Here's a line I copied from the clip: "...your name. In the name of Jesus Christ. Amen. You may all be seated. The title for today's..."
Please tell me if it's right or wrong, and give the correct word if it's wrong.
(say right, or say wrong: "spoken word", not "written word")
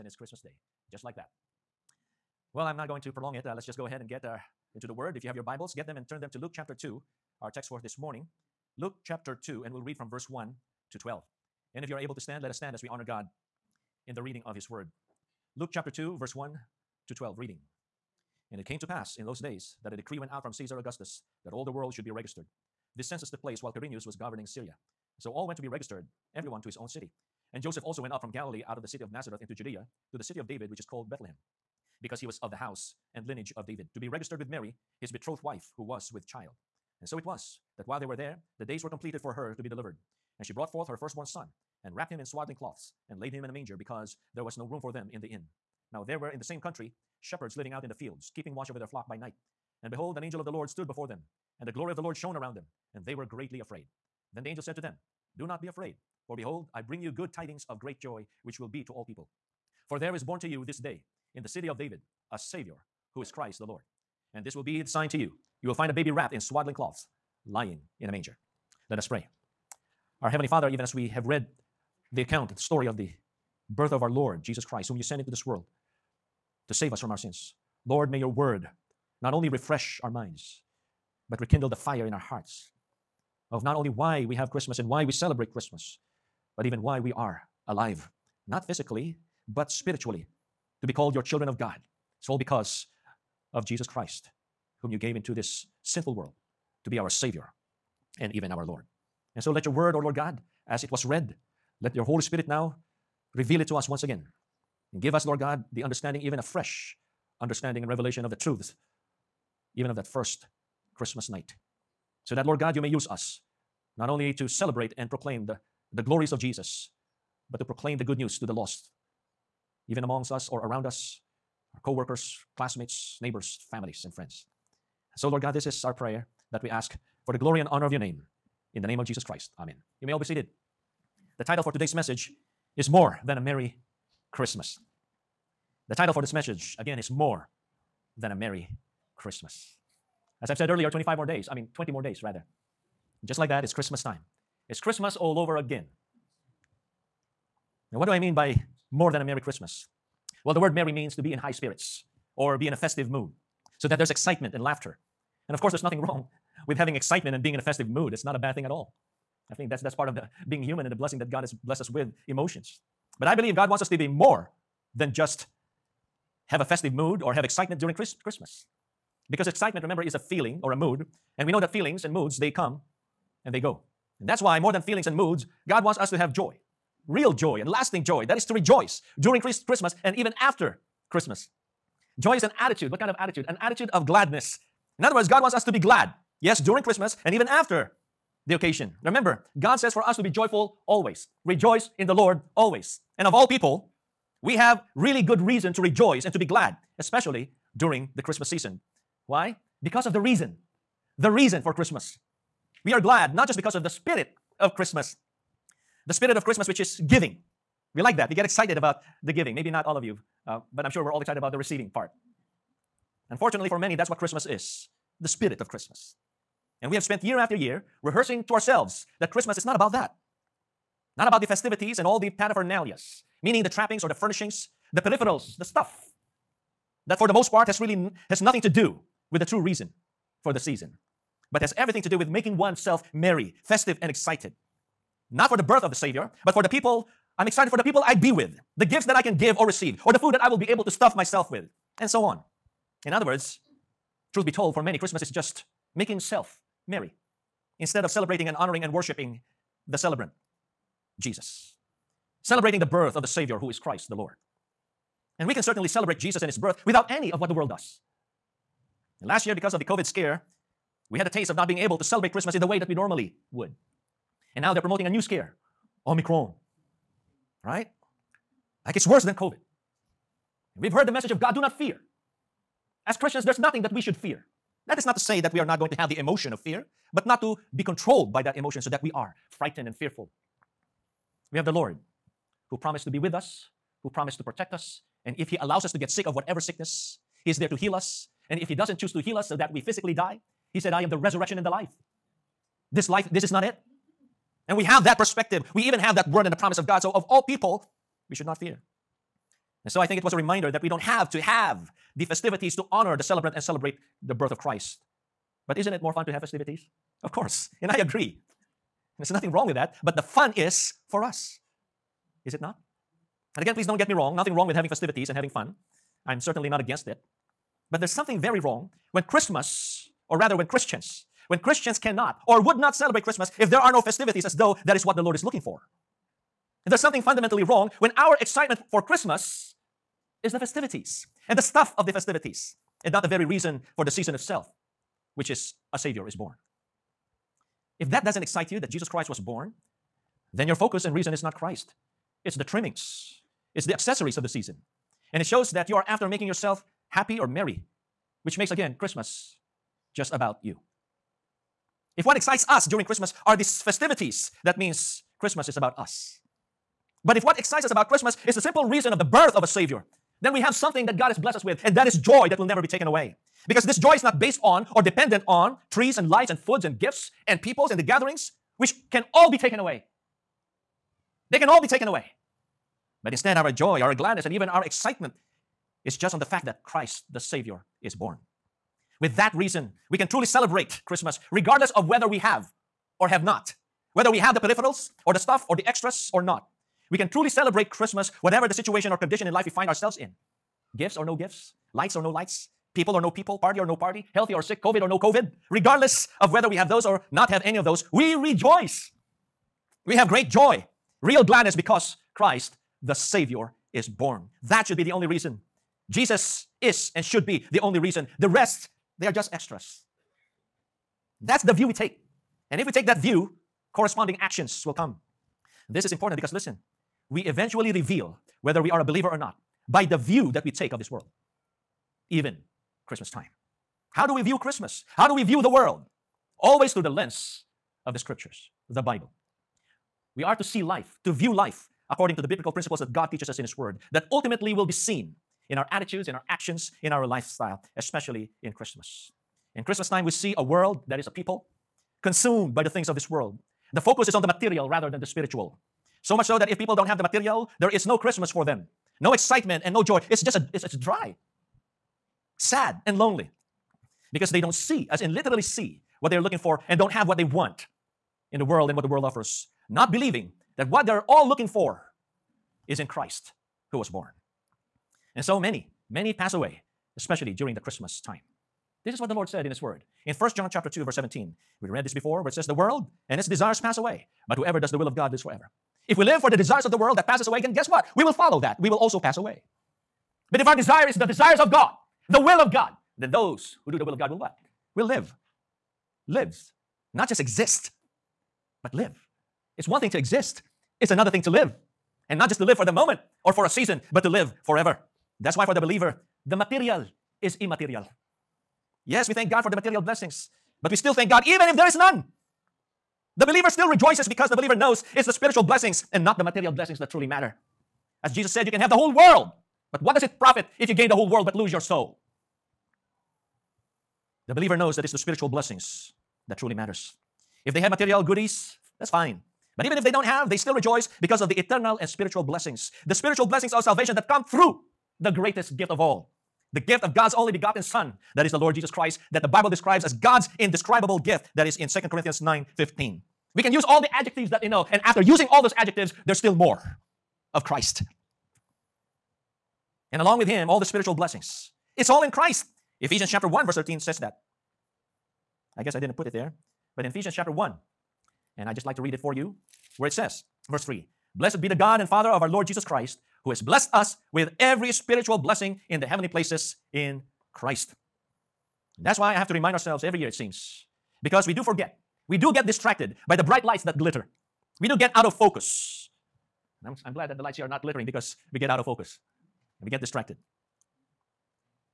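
right.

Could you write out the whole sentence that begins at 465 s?
And so many, many pass away, especially during the Christmas time.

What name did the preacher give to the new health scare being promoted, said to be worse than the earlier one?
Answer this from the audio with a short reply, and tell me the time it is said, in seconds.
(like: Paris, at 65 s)
Omicron, at 266 s.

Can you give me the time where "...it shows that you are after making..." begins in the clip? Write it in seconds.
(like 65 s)
345 s.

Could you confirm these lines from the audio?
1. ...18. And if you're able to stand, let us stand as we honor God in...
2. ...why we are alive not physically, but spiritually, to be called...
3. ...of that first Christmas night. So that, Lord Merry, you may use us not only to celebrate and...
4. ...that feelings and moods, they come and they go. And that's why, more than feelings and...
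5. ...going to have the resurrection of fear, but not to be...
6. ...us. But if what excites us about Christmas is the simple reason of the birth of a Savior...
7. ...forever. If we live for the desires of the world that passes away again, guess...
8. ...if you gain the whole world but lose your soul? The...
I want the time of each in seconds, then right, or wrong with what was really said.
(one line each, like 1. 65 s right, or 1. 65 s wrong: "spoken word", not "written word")
1. 10 s wrong: "12", not "18"
2. 86 s right
3. 109 s wrong: "God", not "Merry"
4. 171 s right
5. 275 s wrong: "emotion", not "resurrection"
6. 355 s right
7. 475 s right
8. 510 s right.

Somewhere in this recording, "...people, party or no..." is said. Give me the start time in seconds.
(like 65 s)
393 s.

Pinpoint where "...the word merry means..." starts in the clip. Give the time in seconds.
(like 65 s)
150 s.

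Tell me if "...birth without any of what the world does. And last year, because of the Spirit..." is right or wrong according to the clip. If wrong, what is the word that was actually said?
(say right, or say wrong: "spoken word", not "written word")
wrong: "COVID", not "Spirit".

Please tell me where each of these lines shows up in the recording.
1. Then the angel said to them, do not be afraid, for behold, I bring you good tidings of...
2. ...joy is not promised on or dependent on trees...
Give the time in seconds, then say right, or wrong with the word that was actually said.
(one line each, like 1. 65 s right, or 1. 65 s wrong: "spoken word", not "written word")
1. 54 s right
2. 363 s wrong: "based", not "promised".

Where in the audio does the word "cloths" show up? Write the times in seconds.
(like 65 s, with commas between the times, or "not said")
42 s, 66 s.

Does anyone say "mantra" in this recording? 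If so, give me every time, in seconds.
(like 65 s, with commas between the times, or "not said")
not said.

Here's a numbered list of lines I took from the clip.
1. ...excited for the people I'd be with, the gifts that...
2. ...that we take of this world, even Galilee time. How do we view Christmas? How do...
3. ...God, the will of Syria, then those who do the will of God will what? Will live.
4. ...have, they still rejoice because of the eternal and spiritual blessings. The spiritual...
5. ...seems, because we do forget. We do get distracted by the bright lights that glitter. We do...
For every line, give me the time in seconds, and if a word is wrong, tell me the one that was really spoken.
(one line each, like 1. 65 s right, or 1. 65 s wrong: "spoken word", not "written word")
1. 237 s right
2. 420 s wrong: "Christmas", not "Galilee"
3. 481 s wrong: "God", not "Syria"
4. 520 s right
5. 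560 s right.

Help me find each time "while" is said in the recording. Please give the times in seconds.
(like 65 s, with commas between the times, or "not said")
23 s, 37 s.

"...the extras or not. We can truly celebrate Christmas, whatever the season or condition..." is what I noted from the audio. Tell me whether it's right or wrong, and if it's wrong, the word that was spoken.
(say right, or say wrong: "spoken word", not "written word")
wrong: "situation", not "season".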